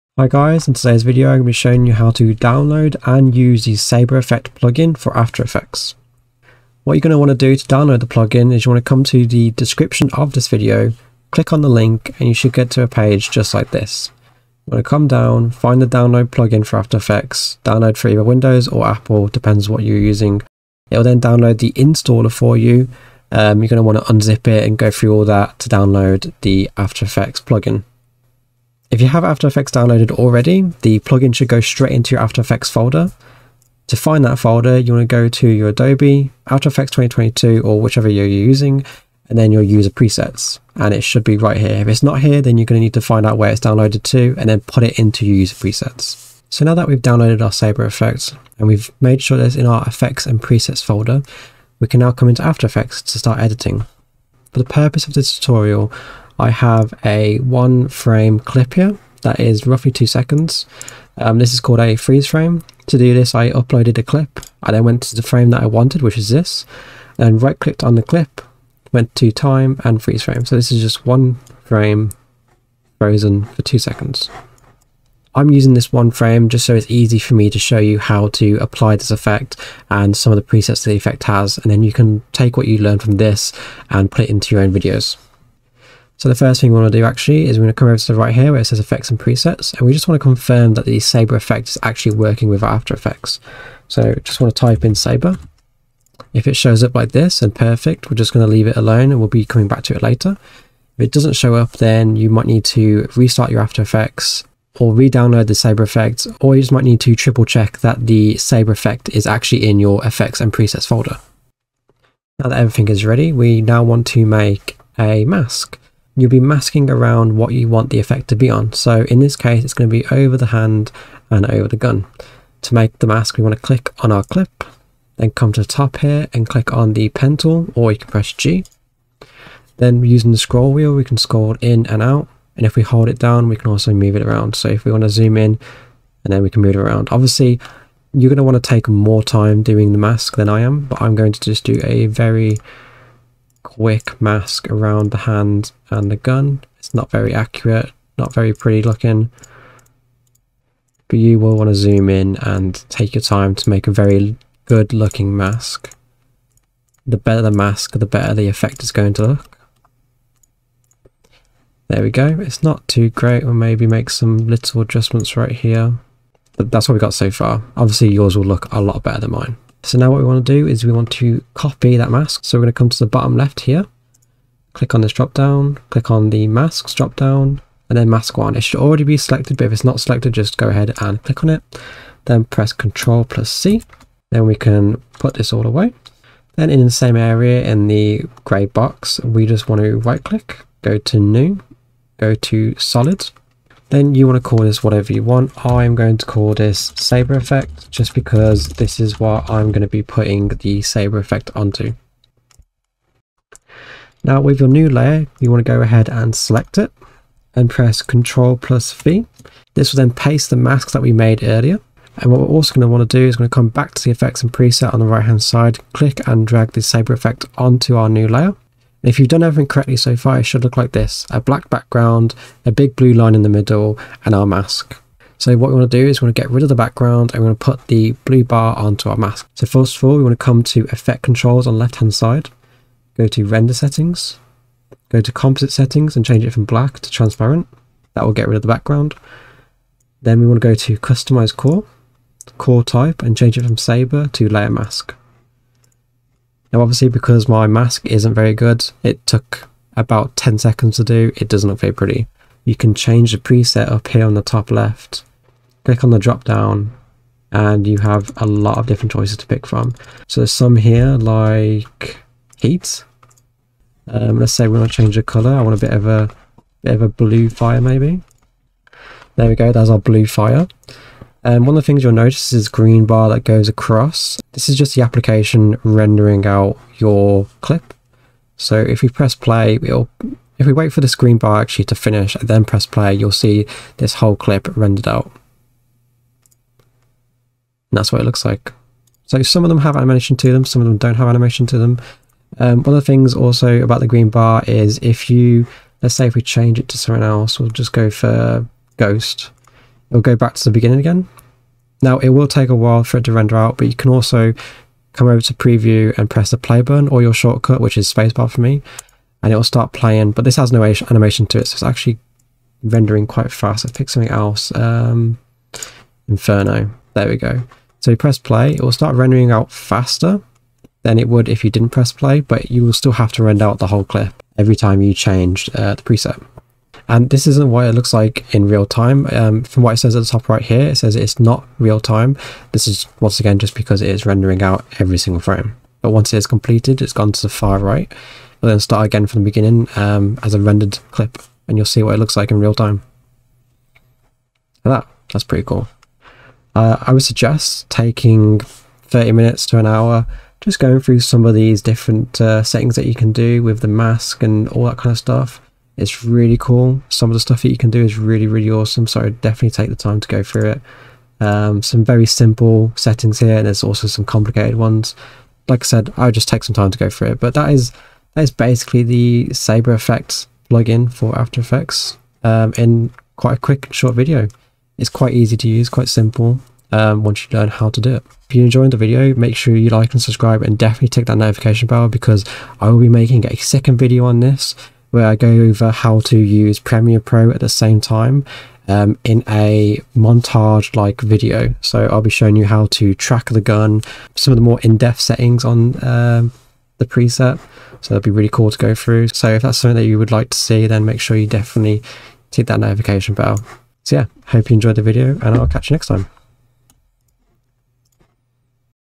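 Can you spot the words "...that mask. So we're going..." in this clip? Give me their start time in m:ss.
2:51.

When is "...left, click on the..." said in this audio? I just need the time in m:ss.
4:14.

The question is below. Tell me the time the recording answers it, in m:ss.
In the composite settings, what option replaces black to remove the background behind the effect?
3:57.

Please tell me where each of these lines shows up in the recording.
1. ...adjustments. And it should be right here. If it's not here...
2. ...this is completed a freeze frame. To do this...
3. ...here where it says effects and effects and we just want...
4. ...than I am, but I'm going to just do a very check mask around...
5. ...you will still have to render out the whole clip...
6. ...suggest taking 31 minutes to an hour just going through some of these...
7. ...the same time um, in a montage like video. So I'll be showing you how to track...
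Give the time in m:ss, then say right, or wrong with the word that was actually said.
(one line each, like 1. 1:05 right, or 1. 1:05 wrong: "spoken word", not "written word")
1. 0:39 wrong: "presets", not "adjustments"
2. 1:01 wrong: "called", not "completed"
3. 1:28 wrong: "presets", not "effects"
4. 2:20 wrong: "quick", not "check"
5. 5:22 right
6. 5:47 wrong: "30", not "31"
7. 6:27 right.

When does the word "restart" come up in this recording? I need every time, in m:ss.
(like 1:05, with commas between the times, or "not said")
1:43.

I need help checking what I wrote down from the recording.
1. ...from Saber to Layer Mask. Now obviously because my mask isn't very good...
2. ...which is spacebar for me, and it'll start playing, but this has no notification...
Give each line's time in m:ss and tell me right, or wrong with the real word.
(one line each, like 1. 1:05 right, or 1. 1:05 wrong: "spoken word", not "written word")
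1. 4:03 right
2. 5:07 wrong: "animation", not "notification".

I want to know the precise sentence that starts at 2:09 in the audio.
Then using the scroll wheel, we can scroll in and out.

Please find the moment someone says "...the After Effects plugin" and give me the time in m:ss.
0:26.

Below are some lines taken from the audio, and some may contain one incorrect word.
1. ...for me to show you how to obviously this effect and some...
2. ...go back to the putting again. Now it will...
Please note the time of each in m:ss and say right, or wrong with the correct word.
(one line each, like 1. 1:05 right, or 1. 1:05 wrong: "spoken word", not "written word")
1. 1:17 wrong: "apply", not "obviously"
2. 5:00 wrong: "beginning", not "putting".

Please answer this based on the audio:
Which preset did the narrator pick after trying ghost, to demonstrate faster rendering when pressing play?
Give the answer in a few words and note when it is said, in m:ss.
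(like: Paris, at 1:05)
Inferno, at 5:16.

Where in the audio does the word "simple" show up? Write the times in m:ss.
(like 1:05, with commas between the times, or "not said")
6:02, 6:16.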